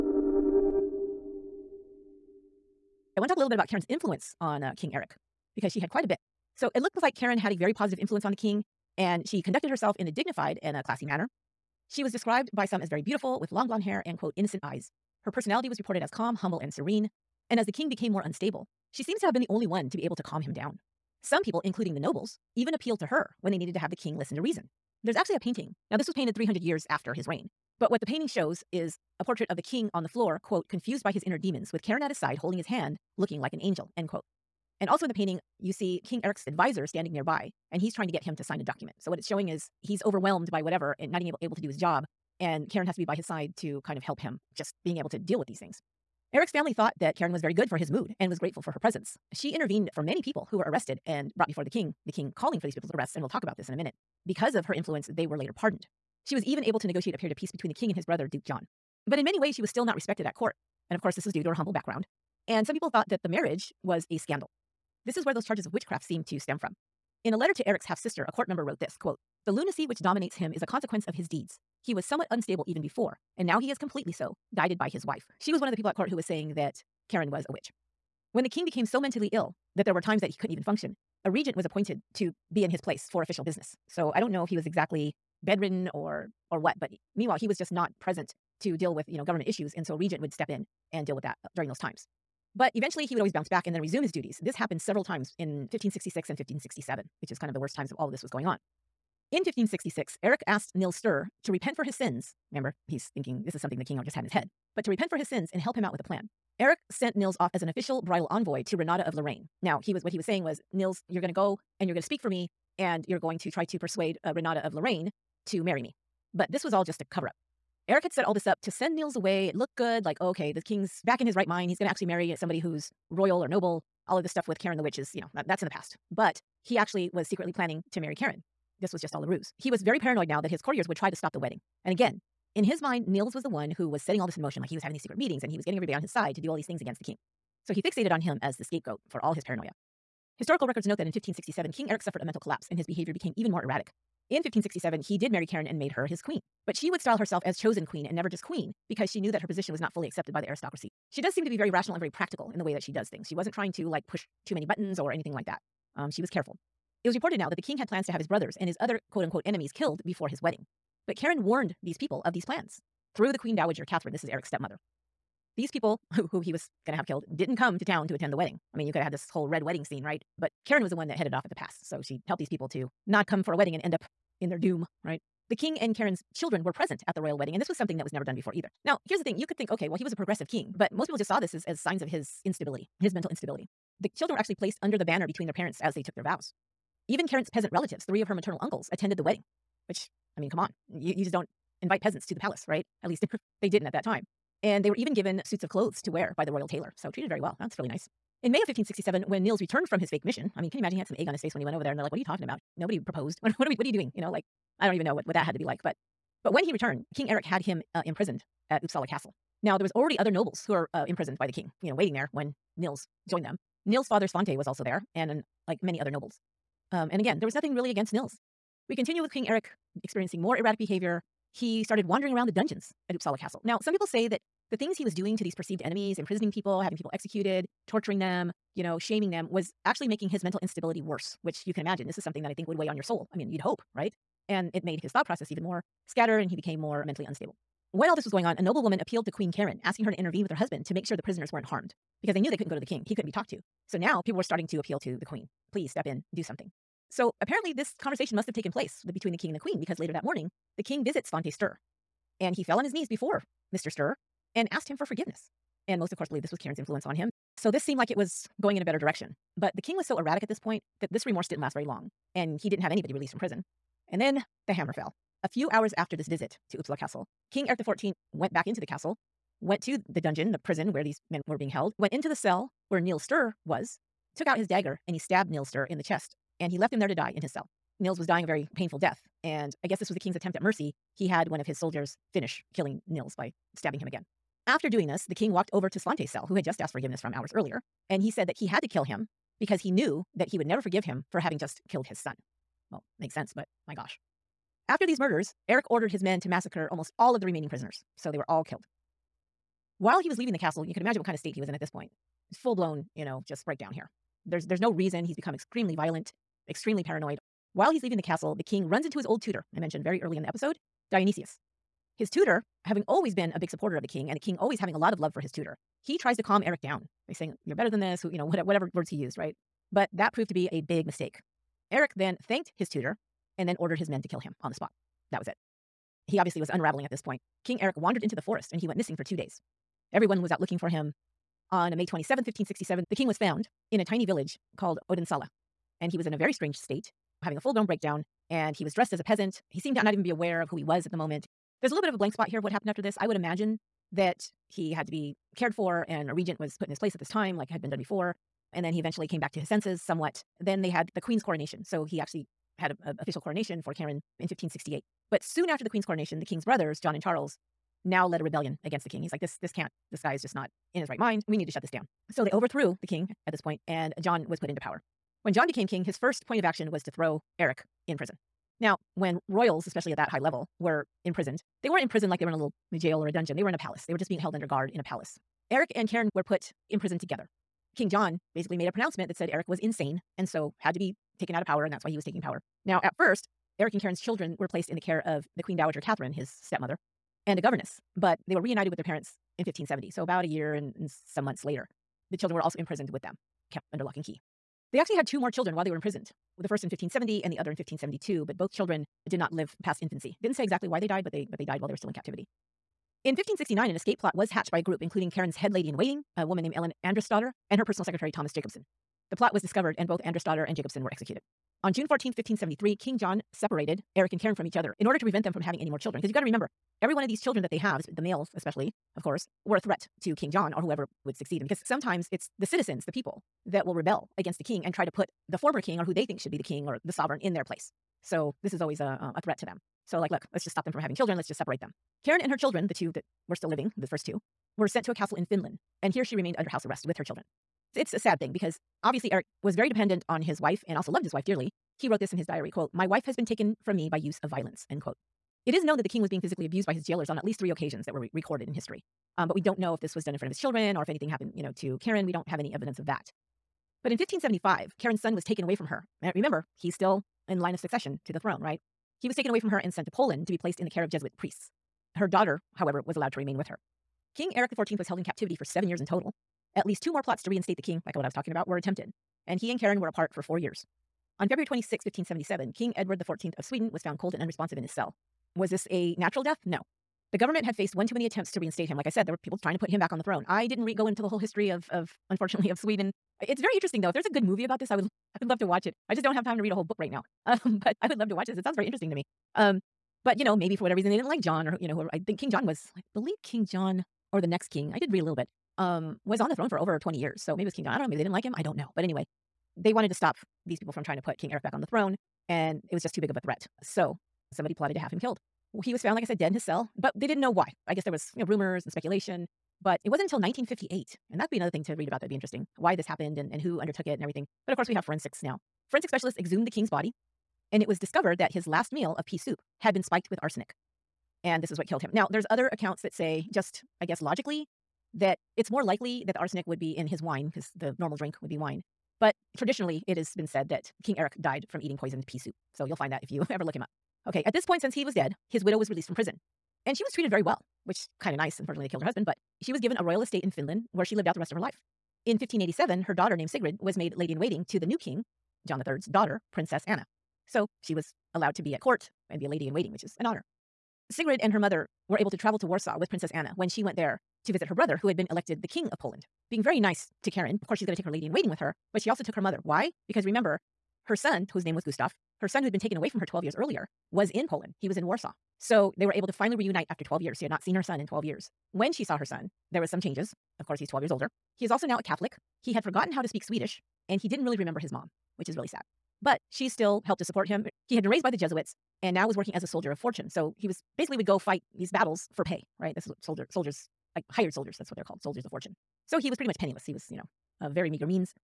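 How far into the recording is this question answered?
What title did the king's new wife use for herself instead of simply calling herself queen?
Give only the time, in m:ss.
2:27.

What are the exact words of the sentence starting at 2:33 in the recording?
She wasn't trying to like push too many buttons or anything like that.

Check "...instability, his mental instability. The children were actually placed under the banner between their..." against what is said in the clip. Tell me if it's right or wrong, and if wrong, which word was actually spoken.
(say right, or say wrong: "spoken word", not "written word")
right.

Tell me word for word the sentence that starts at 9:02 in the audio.
In 1587, her daughter named Sigrid was made lady in waiting to the new king, John III's daughter, Princess Anna.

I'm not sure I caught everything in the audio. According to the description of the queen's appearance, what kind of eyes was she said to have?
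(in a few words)
innocent eyes.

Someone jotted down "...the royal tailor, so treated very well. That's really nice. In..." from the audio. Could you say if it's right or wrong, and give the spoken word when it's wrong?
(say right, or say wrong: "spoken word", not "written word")
right.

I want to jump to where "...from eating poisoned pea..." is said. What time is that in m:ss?
8:51.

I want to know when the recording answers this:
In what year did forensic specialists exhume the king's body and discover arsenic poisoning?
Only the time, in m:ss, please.
8:30.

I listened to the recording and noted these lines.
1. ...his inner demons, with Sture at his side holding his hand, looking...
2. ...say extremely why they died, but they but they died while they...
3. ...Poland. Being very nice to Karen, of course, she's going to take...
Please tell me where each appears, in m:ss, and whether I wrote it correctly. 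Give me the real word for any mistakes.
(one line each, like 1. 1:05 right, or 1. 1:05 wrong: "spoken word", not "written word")
1. 0:31 wrong: "Karen", not "Sture"
2. 6:40 wrong: "exactly", not "extremely"
3. 9:15 right.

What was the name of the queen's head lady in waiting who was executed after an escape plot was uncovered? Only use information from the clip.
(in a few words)
Ellen Andersdotter.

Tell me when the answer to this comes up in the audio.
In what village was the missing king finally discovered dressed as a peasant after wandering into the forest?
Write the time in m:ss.
5:35.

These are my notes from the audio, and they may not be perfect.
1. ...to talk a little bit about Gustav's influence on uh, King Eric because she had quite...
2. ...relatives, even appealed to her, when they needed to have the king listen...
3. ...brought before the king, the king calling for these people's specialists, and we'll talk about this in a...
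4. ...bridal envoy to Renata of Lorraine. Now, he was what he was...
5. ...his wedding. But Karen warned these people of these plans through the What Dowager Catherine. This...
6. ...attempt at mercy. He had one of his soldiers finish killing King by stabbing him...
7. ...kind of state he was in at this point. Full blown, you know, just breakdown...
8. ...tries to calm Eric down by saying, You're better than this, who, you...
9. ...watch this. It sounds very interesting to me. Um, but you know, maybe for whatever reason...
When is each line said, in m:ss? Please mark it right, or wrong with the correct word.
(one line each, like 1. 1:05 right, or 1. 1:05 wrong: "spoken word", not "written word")
1. 0:03 wrong: "Karen", not "Gustav"
2. 0:21 wrong: "nobles", not "relatives"
3. 0:51 wrong: "arrests", not "specialists"
4. 1:48 right
5. 2:40 wrong: "Queen", not "What"
6. 4:40 wrong: "Nils", not "King"
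7. 5:01 right
8. 5:16 right
9. 8:08 right.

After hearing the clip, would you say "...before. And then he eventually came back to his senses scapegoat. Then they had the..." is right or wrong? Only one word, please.
wrong.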